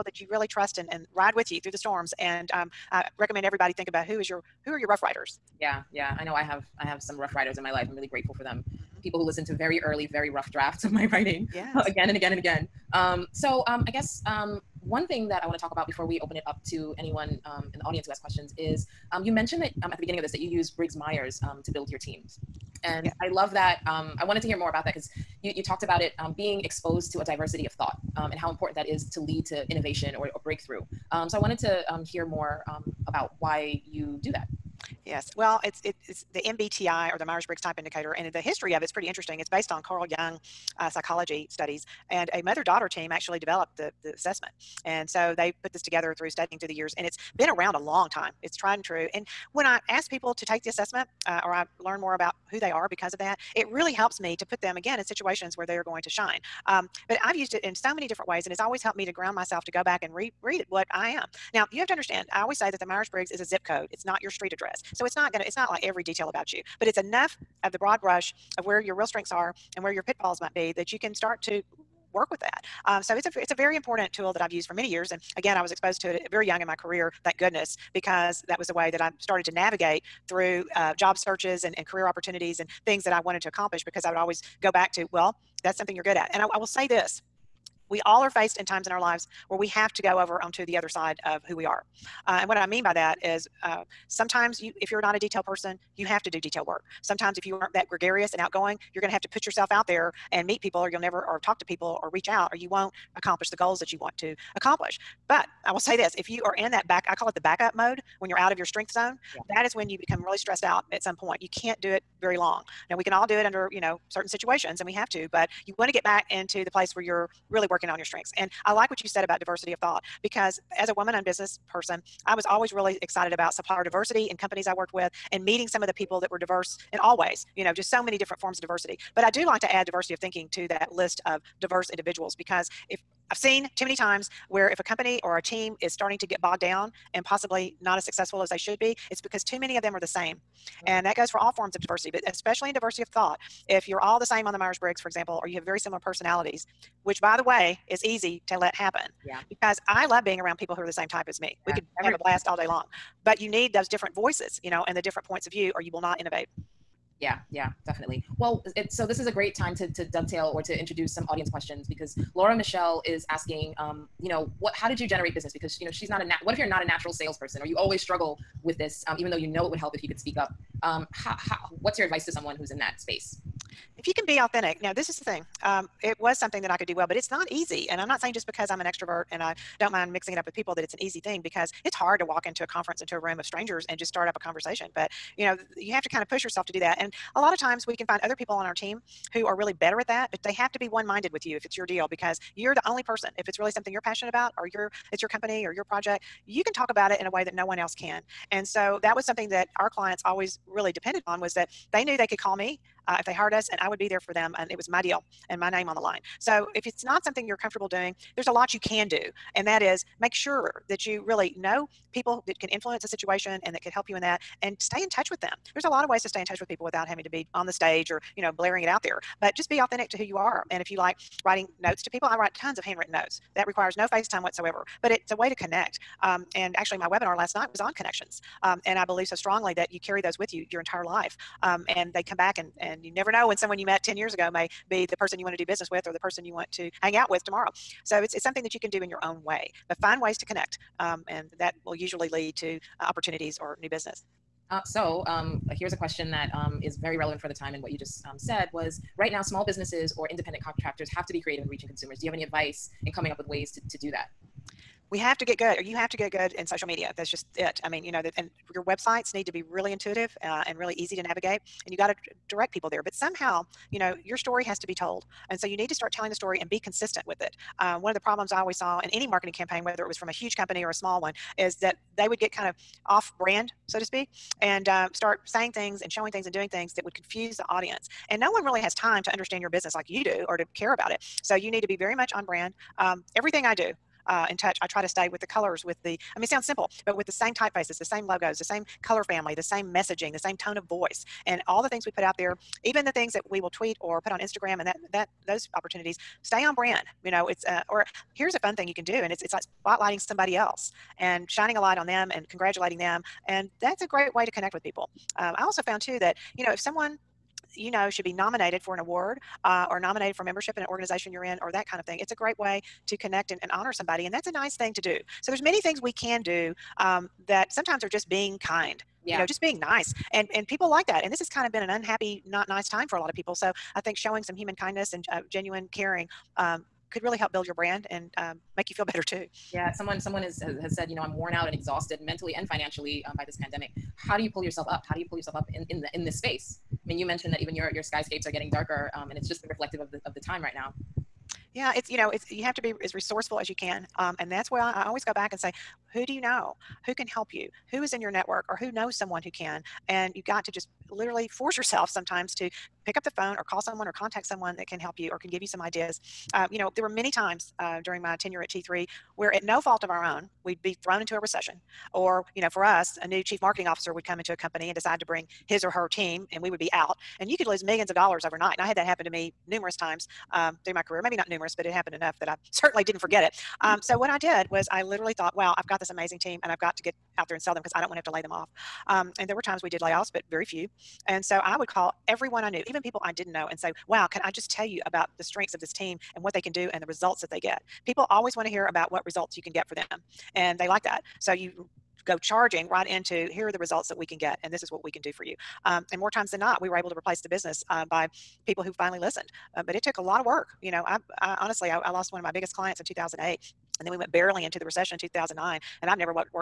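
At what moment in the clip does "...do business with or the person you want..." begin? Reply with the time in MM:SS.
03:55.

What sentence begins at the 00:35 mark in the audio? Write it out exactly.
Well, it's it is the MBTI or the Myers Briggs Type Indicator, and the history of it's pretty interesting.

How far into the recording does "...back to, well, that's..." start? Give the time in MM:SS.
01:24.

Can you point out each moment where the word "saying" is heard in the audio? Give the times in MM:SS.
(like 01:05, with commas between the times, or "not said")
02:58, 04:35.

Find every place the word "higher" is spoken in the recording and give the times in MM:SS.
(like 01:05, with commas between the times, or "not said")
not said.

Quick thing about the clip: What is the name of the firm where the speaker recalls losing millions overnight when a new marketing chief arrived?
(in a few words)
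T3.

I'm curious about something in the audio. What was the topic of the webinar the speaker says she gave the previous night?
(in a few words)
Connections.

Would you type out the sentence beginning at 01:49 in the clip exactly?
that is when you become really stressed out at some point.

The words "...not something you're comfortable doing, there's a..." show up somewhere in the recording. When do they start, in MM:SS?
03:27.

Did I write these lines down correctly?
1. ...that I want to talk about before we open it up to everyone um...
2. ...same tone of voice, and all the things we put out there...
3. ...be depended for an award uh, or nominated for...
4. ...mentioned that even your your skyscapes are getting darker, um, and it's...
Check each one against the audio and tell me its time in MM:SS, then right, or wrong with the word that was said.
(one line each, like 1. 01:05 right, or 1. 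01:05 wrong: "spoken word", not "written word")
1. 00:15 wrong: "anyone", not "everyone"
2. 04:50 right
3. 05:08 wrong: "nominated", not "depended"
4. 05:37 right.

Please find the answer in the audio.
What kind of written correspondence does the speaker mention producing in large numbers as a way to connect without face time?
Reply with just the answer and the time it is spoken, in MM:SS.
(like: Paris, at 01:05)
Handwritten notes, at 03:42.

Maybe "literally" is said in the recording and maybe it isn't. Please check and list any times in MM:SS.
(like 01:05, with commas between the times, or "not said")
05:51, 06:15.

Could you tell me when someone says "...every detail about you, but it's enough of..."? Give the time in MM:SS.
01:05.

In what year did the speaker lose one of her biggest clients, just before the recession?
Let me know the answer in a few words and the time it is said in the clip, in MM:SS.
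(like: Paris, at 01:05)
2008, at 06:43.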